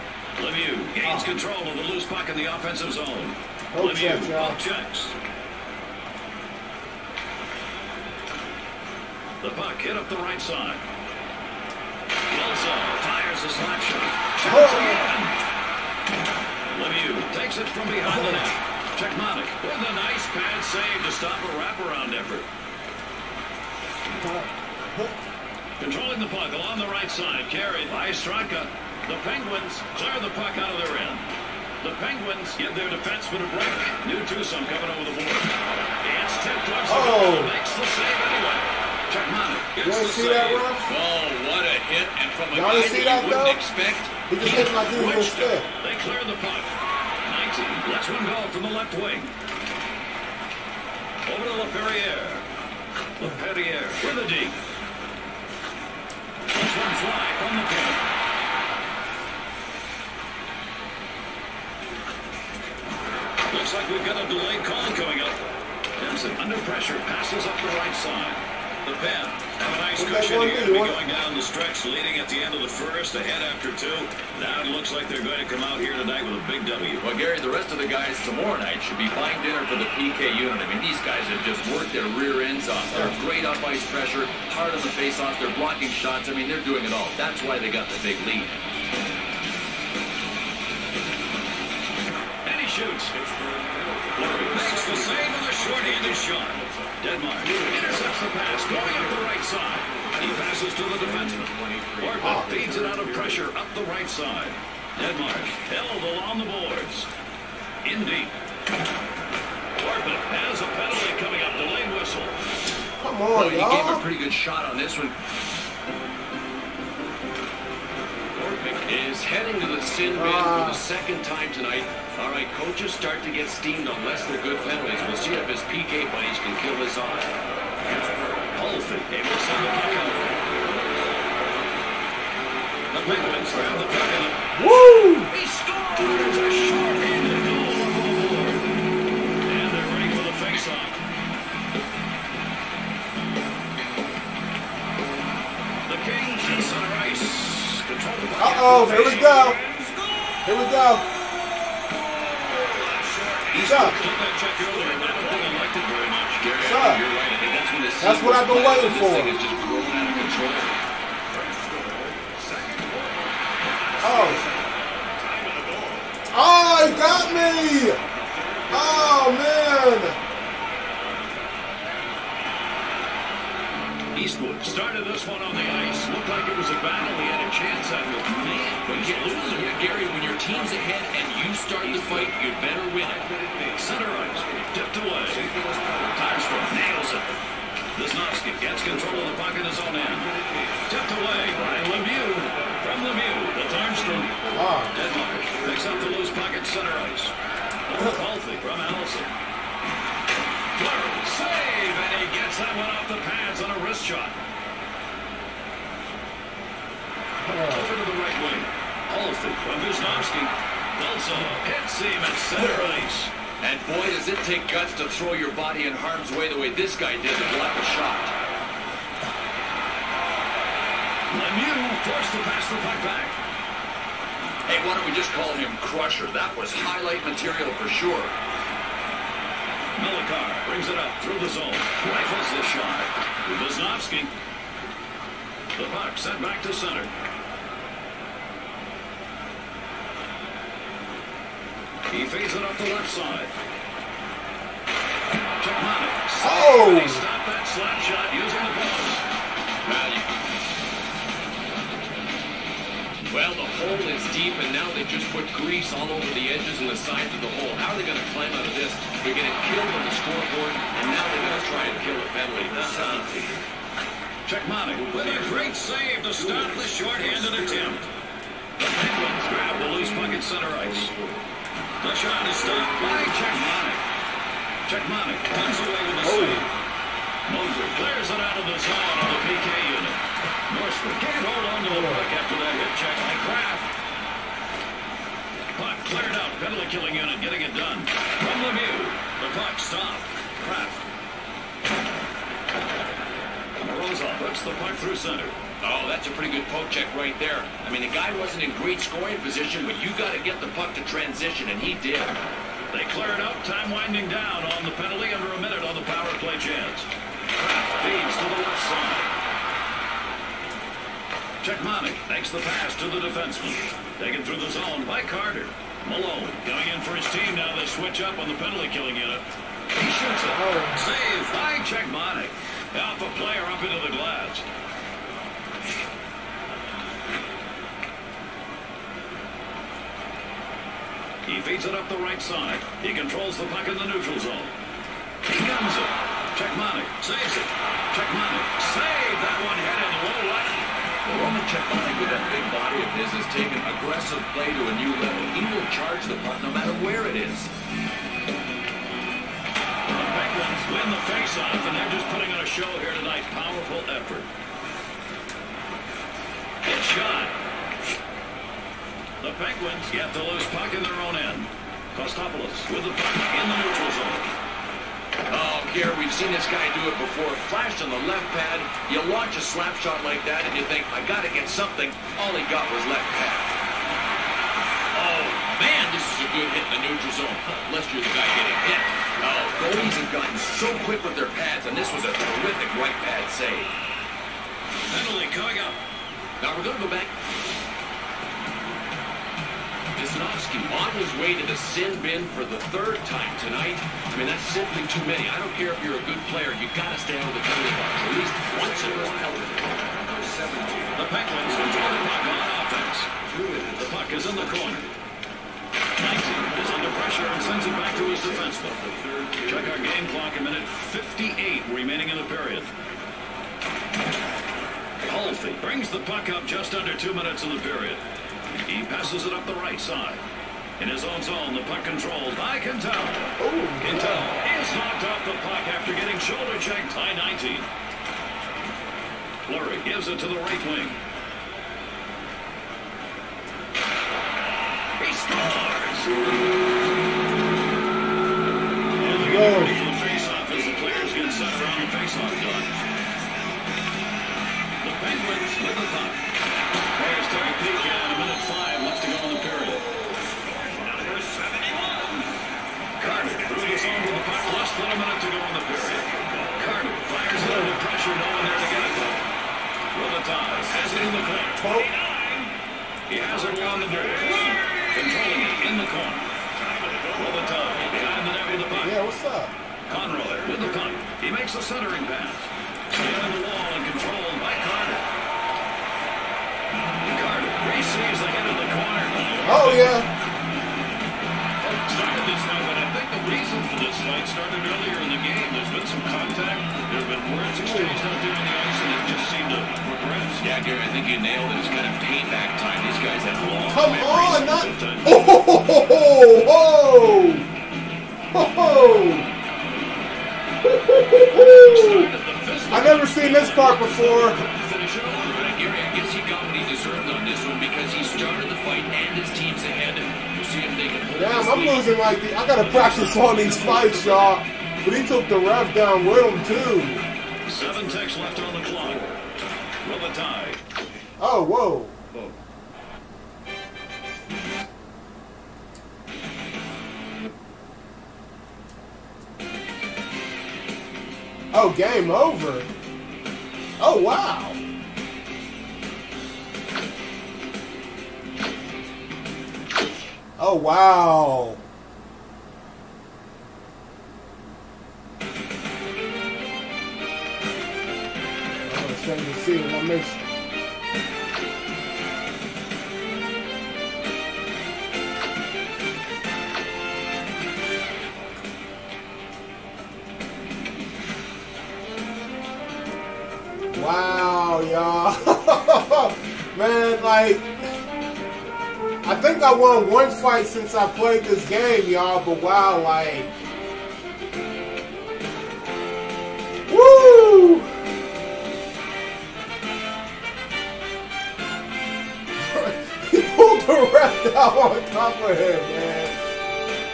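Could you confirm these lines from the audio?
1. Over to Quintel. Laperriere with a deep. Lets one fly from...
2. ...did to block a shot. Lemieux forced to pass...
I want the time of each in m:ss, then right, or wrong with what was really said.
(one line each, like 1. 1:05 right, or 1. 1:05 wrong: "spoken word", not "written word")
1. 0:51 wrong: "Laperriere", not "Quintel"
2. 3:37 right.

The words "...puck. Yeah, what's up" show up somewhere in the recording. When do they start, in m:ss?
7:48.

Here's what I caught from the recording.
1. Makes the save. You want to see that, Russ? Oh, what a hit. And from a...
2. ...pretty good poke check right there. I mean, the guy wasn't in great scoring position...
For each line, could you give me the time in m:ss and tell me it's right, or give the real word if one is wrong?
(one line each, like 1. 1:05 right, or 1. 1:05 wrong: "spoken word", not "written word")
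1. 0:37 right
2. 4:56 right.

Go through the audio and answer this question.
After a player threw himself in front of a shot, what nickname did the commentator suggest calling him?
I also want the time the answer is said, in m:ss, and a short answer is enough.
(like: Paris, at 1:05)
Crusher, at 3:45.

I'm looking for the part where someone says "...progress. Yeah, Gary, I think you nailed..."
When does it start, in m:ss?
8:09.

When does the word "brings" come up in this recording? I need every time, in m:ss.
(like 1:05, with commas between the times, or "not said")
3:50, 6:55.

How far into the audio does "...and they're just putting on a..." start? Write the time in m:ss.
5:51.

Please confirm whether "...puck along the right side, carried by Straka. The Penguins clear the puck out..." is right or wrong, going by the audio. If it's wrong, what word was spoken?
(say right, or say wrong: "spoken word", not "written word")
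right.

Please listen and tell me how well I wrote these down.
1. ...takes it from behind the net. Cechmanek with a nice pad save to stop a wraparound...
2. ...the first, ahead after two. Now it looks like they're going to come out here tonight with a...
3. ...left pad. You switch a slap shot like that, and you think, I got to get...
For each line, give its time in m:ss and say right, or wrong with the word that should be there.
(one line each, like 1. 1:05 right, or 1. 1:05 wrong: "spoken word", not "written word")
1. 0:17 right
2. 1:12 right
3. 6:08 wrong: "launch", not "switch".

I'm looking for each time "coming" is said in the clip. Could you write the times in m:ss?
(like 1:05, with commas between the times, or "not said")
0:34, 1:04, 1:51, 5:16, 6:25.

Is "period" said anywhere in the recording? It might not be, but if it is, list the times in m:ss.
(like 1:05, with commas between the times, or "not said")
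6:52, 6:57, 7:35.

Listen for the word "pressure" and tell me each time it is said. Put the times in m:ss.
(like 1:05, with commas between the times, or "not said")
1:06, 1:23, 1:43, 6:47, 7:38.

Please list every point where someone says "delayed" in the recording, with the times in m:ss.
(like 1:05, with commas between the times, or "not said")
1:04, 1:51.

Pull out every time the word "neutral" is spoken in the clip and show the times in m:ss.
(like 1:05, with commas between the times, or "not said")
5:34, 6:03, 6:17.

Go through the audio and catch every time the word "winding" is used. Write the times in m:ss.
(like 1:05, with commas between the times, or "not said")
5:03.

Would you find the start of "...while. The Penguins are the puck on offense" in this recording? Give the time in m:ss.
6:39.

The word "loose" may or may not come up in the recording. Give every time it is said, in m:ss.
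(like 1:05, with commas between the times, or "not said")
0:01, 3:16, 4:29, 6:00.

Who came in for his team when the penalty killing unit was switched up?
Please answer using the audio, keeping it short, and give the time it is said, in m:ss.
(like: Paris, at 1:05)
Malone, at 5:16.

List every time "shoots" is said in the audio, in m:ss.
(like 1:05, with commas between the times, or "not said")
1:32, 5:20.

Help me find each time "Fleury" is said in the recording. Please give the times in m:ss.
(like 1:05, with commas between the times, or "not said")
3:20, 7:09.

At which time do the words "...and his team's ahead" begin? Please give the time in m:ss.
8:29.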